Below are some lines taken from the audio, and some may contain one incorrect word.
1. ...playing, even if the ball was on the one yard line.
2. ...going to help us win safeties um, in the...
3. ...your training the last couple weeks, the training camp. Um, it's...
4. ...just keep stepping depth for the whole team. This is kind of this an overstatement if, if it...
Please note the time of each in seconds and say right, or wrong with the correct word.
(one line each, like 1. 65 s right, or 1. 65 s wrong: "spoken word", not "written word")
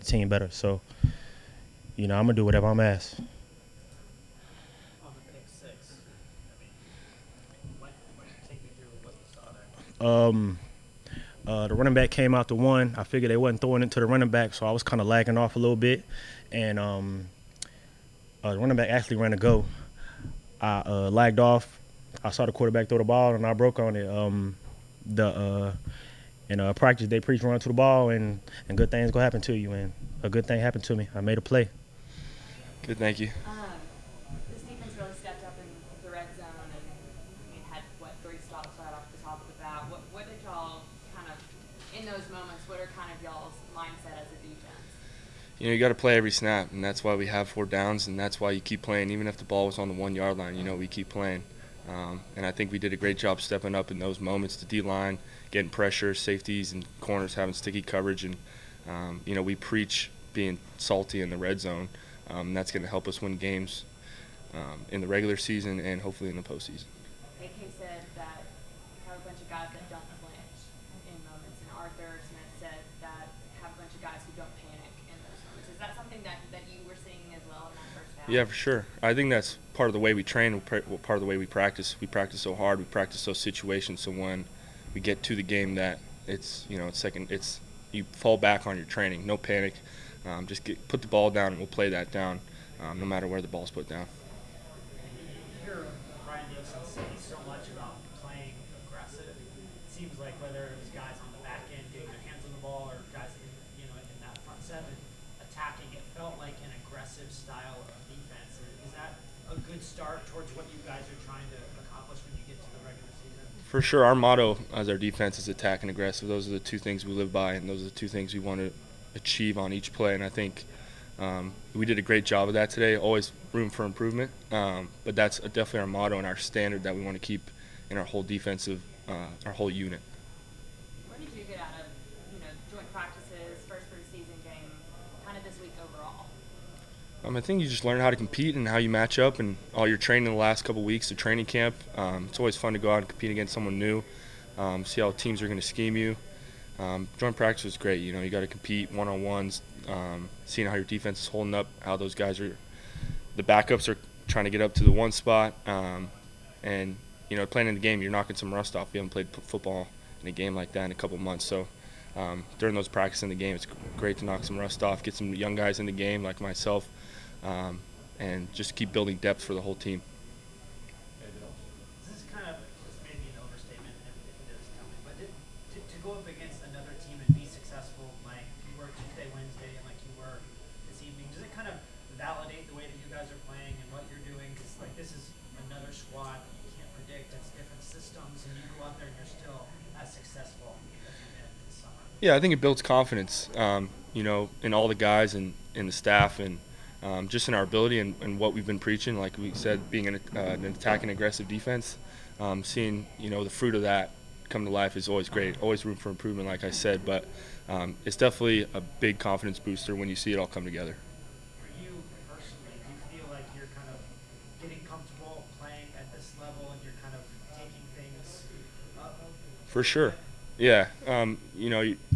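1. 48 s right
2. 62 s wrong: "games", not "safeties"
3. 139 s right
4. 168 s wrong: "building", not "stepping".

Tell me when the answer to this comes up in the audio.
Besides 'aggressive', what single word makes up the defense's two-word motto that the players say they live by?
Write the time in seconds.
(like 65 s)
115 s.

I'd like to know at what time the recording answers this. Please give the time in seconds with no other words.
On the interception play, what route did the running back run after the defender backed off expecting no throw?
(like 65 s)
19 s.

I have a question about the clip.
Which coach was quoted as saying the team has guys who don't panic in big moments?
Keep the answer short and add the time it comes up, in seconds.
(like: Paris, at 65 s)
Arthur Smith, at 71 s.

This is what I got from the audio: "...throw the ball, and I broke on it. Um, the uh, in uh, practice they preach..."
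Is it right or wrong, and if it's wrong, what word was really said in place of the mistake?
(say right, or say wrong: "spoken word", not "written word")
right.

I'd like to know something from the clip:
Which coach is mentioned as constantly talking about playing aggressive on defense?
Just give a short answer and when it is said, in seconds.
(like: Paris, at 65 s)
Ryan Nielsen, at 96 s.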